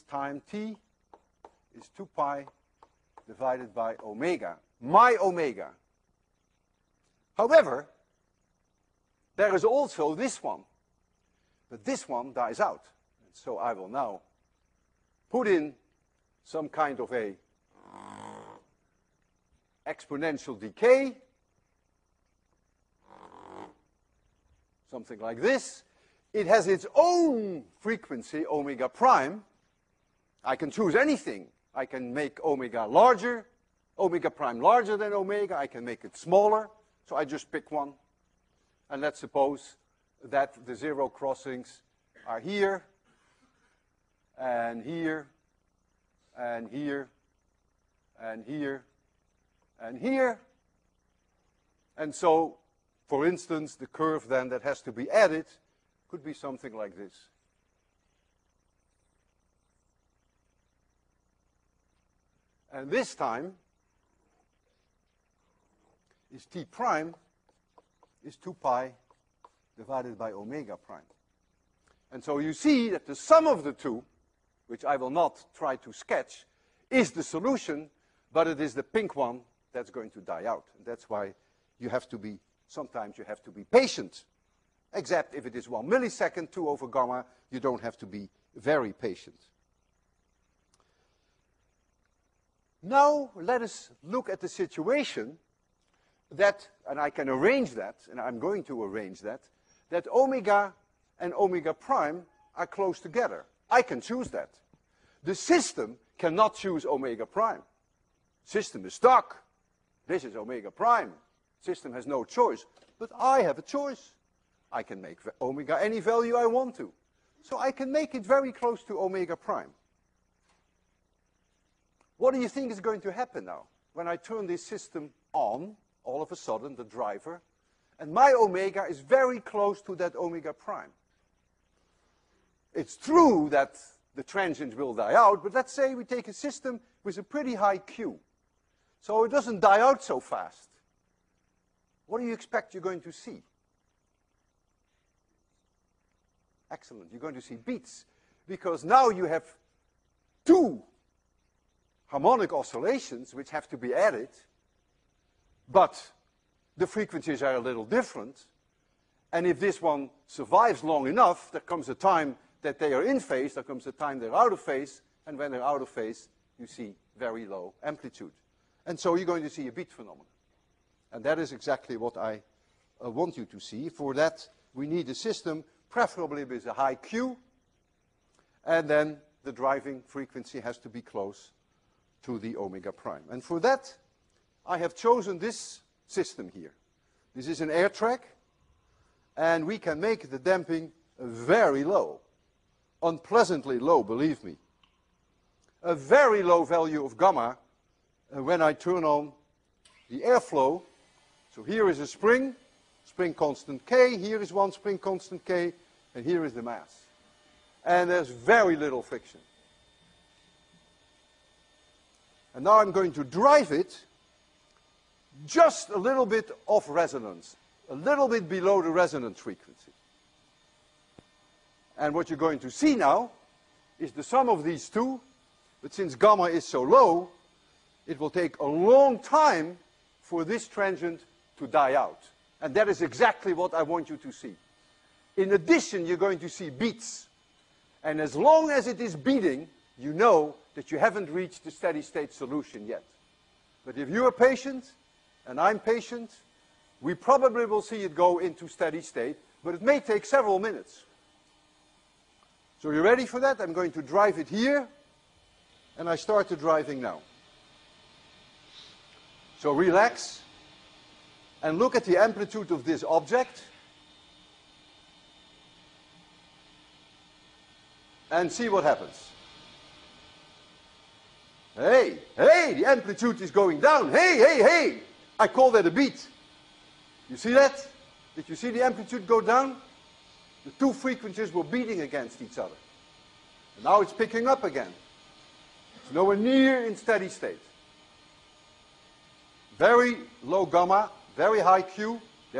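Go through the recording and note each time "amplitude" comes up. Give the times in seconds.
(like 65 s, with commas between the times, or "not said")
167 s, 262 s, 272 s, 278 s.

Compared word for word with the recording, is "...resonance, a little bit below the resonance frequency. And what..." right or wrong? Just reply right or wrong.
right.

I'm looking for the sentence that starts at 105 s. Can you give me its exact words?
The system cannot choose omega prime.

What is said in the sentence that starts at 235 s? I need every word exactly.
In addition, you're going to see beats.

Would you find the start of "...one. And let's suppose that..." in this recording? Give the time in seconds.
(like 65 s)
37 s.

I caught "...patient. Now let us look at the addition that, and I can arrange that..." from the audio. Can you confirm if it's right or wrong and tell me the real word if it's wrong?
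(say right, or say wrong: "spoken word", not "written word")
wrong: "situation", not "addition".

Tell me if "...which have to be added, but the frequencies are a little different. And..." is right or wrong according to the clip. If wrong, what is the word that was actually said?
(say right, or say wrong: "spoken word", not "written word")
right.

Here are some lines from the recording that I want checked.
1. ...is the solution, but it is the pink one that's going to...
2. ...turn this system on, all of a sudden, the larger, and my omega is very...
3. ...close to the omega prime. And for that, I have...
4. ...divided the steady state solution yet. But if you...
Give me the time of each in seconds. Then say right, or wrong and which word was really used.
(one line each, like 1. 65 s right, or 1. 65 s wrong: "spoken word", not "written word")
1. 76 s right
2. 124 s wrong: "driver", not "larger"
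3. 181 s right
4. 241 s wrong: "reached", not "divided".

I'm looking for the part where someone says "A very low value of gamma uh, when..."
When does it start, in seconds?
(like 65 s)
195 s.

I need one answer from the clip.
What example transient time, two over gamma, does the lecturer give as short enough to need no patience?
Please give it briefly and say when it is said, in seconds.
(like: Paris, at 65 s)
1 millisecond, at 85 s.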